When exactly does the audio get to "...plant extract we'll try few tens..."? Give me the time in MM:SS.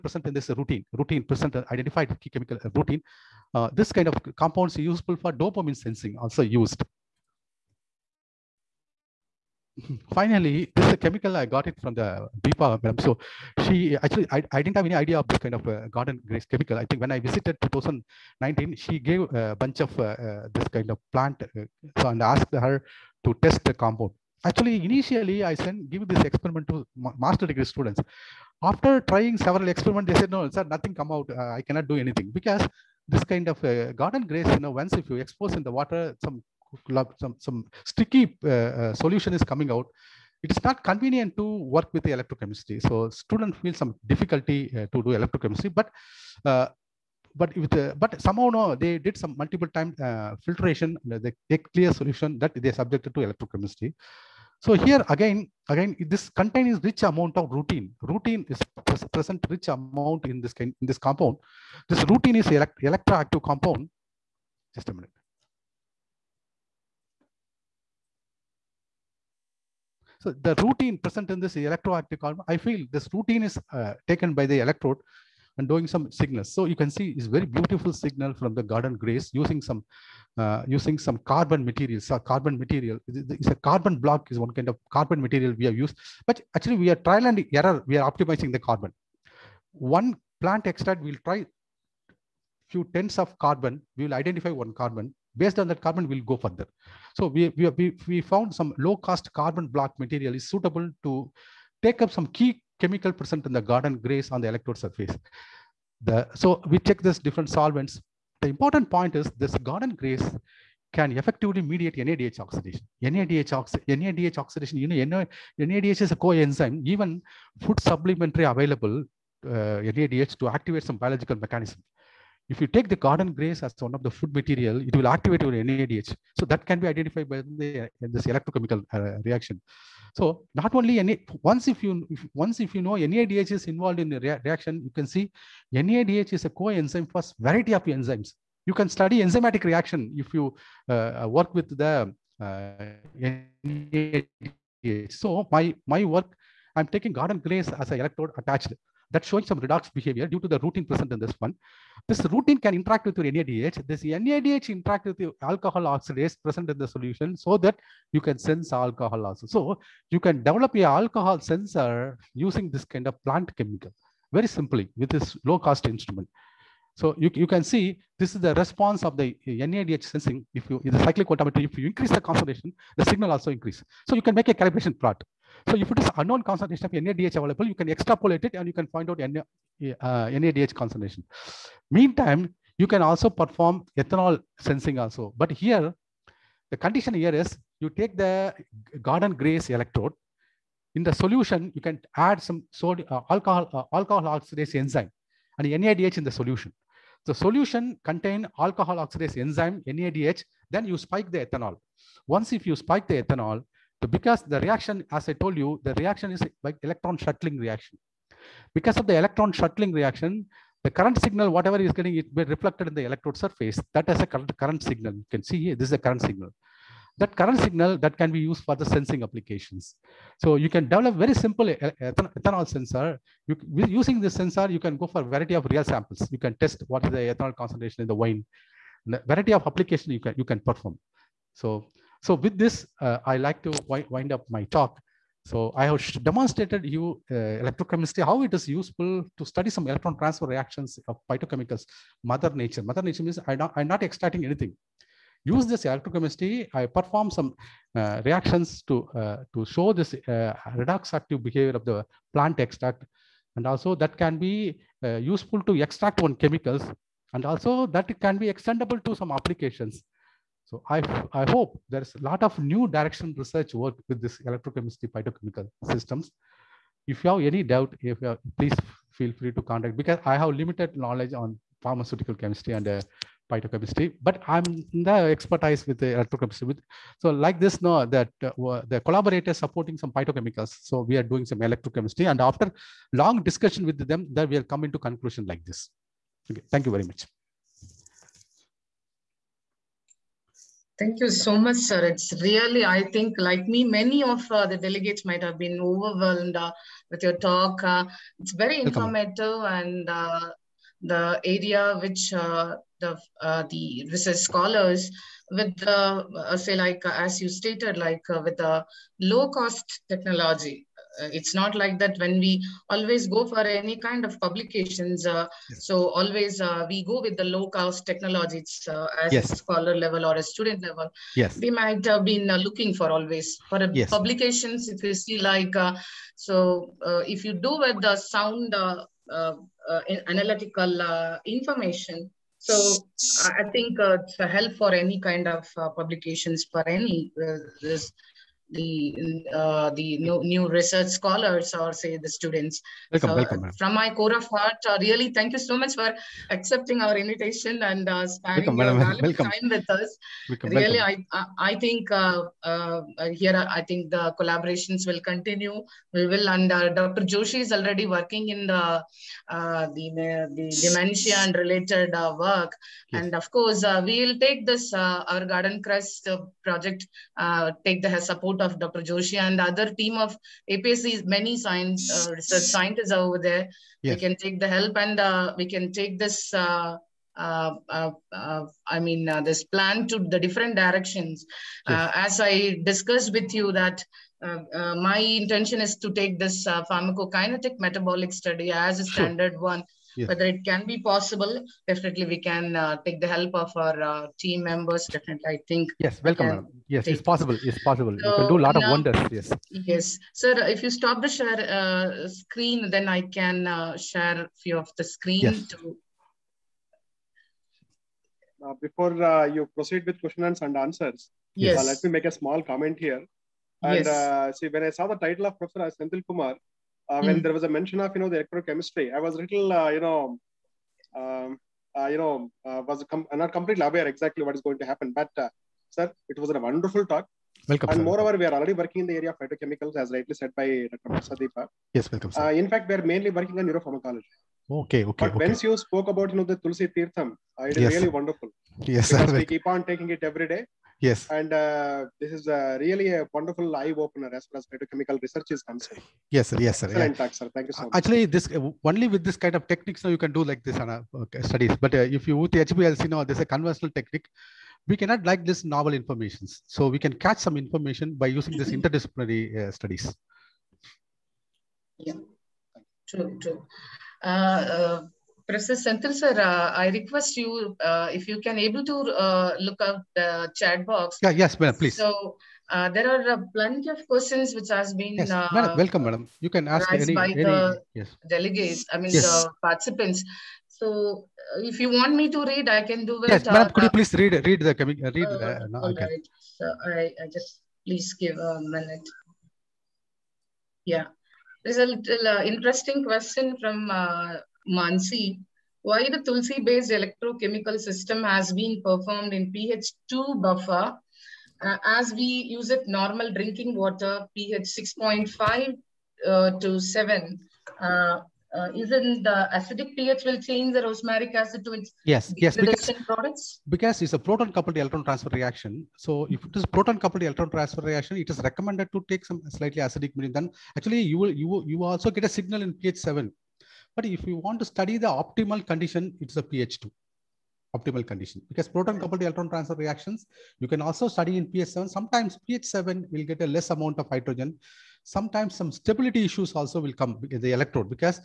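01:30.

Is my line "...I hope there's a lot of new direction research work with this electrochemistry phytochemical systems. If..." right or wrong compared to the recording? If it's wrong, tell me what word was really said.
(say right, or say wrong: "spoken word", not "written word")
right.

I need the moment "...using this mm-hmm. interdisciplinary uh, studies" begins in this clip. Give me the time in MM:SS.
07:38.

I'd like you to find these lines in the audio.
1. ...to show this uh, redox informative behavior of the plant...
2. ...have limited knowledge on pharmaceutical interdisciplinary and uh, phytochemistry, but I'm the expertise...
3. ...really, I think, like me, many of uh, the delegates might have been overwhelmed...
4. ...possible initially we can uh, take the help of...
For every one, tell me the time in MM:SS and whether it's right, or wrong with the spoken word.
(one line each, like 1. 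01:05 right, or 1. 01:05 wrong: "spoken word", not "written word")
1. 04:09 wrong: "active", not "informative"
2. 04:30 wrong: "chemistry", not "interdisciplinary"
3. 04:52 right
4. 06:30 wrong: "definitely", not "initially".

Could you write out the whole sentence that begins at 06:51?
let me make a small comment here.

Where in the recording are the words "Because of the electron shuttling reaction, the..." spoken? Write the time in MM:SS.
03:28.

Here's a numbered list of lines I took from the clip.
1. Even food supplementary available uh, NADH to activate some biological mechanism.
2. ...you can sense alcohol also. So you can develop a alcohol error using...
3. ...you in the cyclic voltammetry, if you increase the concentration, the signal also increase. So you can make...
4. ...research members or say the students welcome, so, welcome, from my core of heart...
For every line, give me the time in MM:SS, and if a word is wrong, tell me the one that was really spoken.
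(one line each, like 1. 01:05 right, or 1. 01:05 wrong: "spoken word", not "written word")
1. 01:56 right
2. 02:38 wrong: "sensor", not "error"
3. 02:50 right
4. 05:40 wrong: "scholars", not "members".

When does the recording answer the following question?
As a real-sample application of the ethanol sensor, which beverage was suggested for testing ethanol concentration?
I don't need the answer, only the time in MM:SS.
03:48.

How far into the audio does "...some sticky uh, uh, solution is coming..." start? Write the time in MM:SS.
00:37.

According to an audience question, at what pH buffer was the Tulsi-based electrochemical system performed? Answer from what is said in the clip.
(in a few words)
pH 2.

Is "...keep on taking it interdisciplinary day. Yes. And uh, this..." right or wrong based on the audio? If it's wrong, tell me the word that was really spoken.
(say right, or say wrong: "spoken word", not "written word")
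wrong: "every", not "interdisciplinary".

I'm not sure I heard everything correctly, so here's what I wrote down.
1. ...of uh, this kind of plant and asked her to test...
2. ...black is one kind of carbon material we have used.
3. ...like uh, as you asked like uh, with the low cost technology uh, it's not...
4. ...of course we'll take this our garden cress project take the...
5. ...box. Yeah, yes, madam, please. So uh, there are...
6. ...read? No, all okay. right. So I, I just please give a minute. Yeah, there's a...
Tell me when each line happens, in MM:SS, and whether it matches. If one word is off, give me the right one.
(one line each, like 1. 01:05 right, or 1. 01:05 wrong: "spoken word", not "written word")
1. 00:19 right
2. 01:23 right
3. 05:06 wrong: "stated", not "asked"
4. 06:03 right
5. 07:50 right
6. 08:05 right.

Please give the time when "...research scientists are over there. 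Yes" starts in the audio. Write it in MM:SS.
06:12.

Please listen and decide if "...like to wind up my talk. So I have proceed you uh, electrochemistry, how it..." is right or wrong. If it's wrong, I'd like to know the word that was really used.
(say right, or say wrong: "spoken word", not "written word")
wrong: "demonstrated", not "proceed".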